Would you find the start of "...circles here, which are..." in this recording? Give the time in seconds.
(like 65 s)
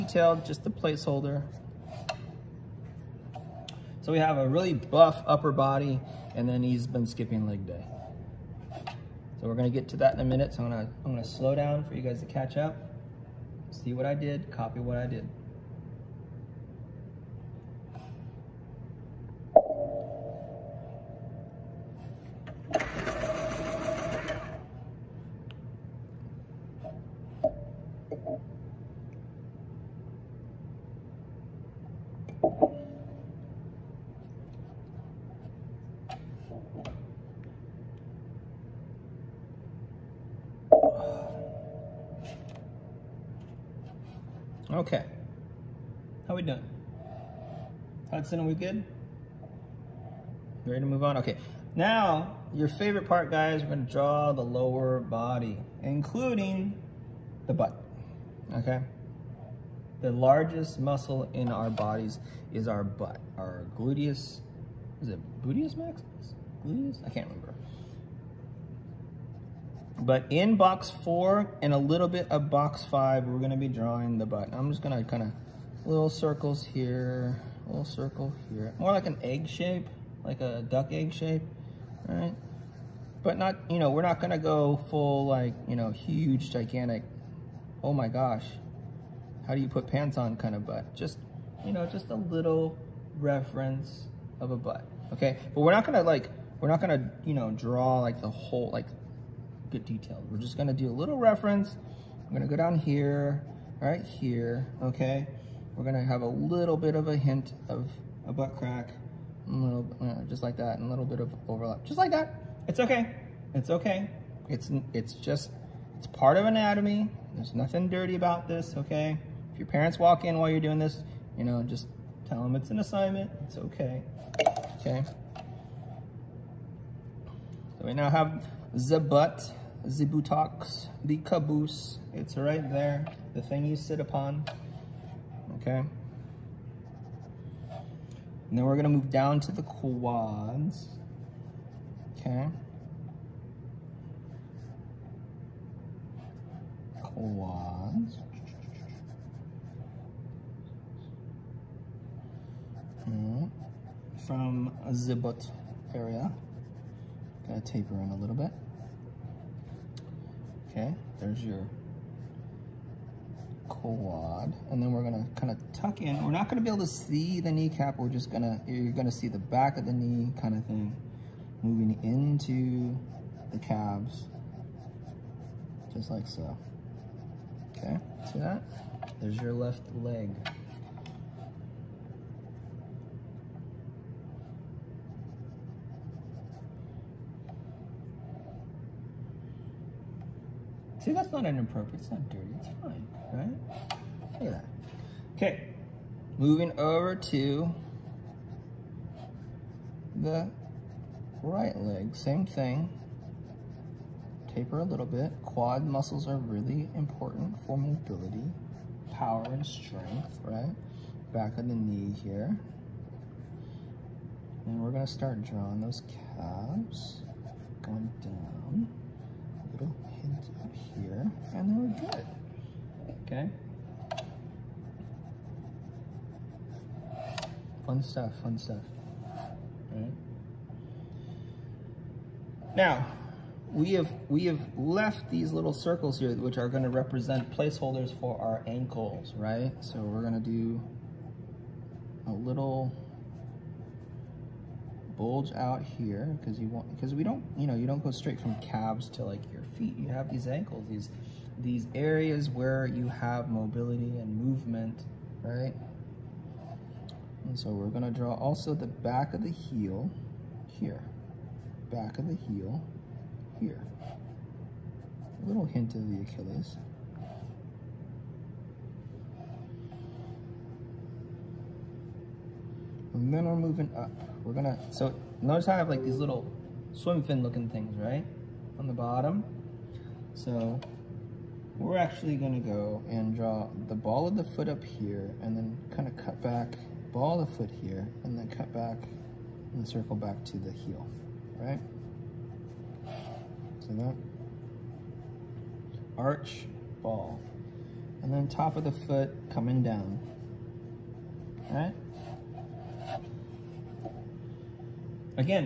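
235 s.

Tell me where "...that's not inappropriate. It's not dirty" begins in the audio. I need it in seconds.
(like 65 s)
191 s.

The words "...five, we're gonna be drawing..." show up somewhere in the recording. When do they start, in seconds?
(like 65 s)
72 s.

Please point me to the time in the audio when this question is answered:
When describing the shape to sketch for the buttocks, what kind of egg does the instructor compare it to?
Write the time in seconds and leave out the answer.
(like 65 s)
80 s.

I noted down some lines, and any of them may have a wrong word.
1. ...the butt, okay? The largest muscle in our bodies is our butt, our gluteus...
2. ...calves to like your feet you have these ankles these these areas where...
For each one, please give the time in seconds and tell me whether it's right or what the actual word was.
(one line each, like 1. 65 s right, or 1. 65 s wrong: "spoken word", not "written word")
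1. 57 s right
2. 248 s right.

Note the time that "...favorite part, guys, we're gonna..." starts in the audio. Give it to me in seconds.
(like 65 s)
52 s.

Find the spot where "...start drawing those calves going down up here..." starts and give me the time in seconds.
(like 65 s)
215 s.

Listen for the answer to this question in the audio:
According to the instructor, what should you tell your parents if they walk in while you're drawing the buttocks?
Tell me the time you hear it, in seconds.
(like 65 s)
122 s.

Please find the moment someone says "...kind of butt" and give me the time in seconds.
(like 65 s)
90 s.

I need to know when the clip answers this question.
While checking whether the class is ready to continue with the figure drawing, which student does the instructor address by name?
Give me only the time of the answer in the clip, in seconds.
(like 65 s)
48 s.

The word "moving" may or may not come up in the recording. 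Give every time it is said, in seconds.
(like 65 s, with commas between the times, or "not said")
171 s, 196 s, 273 s.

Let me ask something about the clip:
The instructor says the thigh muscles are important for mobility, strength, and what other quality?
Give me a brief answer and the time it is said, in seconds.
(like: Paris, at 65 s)
Power, at 209 s.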